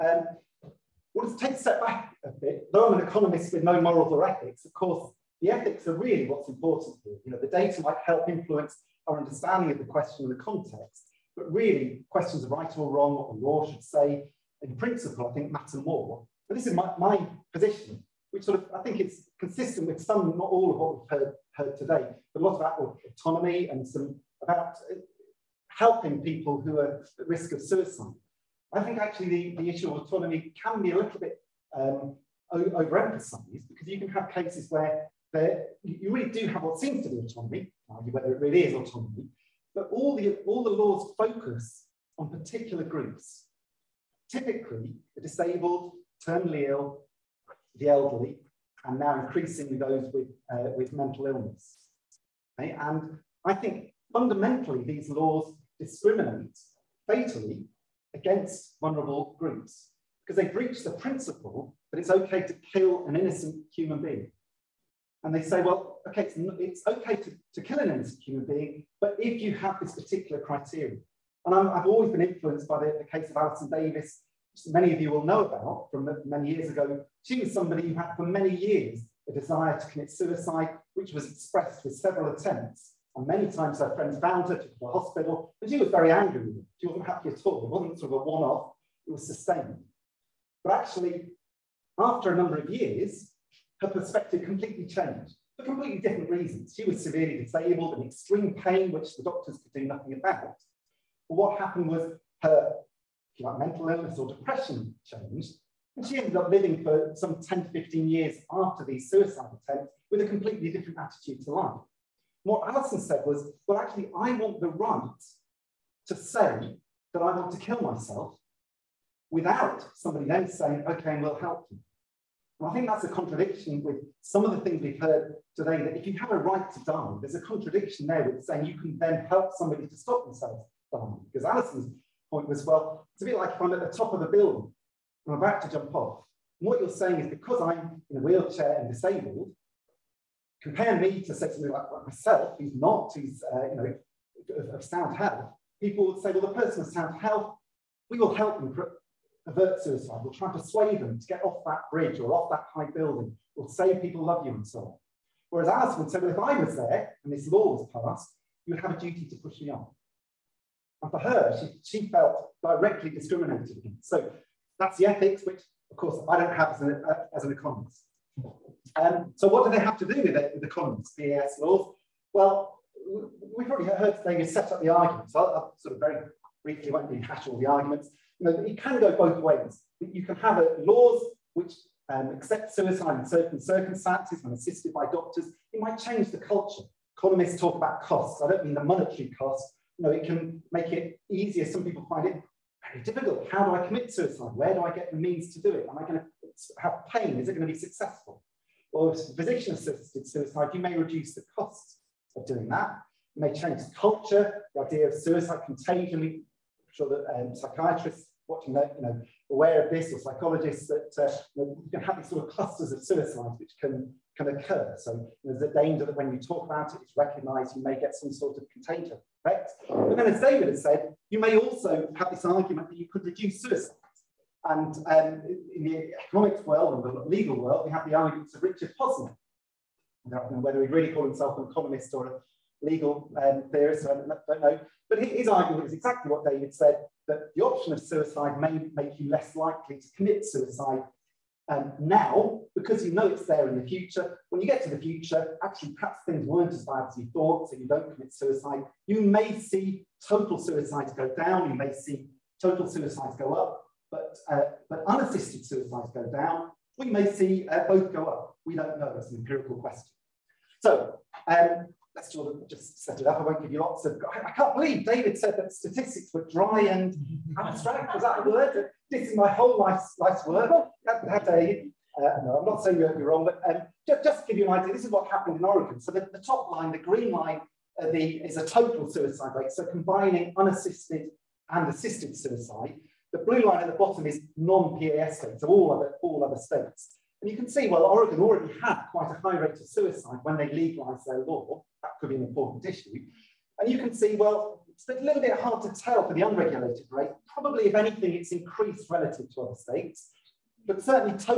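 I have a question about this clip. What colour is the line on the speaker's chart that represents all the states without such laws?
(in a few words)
blue.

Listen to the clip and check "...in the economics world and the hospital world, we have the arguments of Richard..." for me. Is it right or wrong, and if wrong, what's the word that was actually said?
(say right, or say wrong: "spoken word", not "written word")
wrong: "legal", not "hospital".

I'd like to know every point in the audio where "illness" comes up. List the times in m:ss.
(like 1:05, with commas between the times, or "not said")
0:51, 1:43.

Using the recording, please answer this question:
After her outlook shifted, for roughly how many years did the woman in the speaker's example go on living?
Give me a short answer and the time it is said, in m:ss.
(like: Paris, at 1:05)
10 to 15, at 1:47.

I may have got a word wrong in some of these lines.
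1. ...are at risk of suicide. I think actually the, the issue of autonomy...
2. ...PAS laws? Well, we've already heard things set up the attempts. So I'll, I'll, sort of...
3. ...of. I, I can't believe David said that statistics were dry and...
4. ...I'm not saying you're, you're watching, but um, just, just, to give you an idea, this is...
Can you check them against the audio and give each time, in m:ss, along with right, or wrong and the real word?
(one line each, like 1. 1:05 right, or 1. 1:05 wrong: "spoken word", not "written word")
1. 0:26 right
2. 2:51 wrong: "arguments", not "attempts"
3. 4:24 right
4. 4:32 wrong: "wrong", not "watching".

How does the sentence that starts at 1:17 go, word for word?
She was somebody who had for many years a desire to commit suicide, which was expressed with several attempts.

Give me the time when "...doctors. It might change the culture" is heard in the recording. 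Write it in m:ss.
3:05.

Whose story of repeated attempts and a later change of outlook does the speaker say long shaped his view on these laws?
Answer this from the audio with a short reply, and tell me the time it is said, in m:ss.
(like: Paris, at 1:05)
Alison Davis, at 1:13.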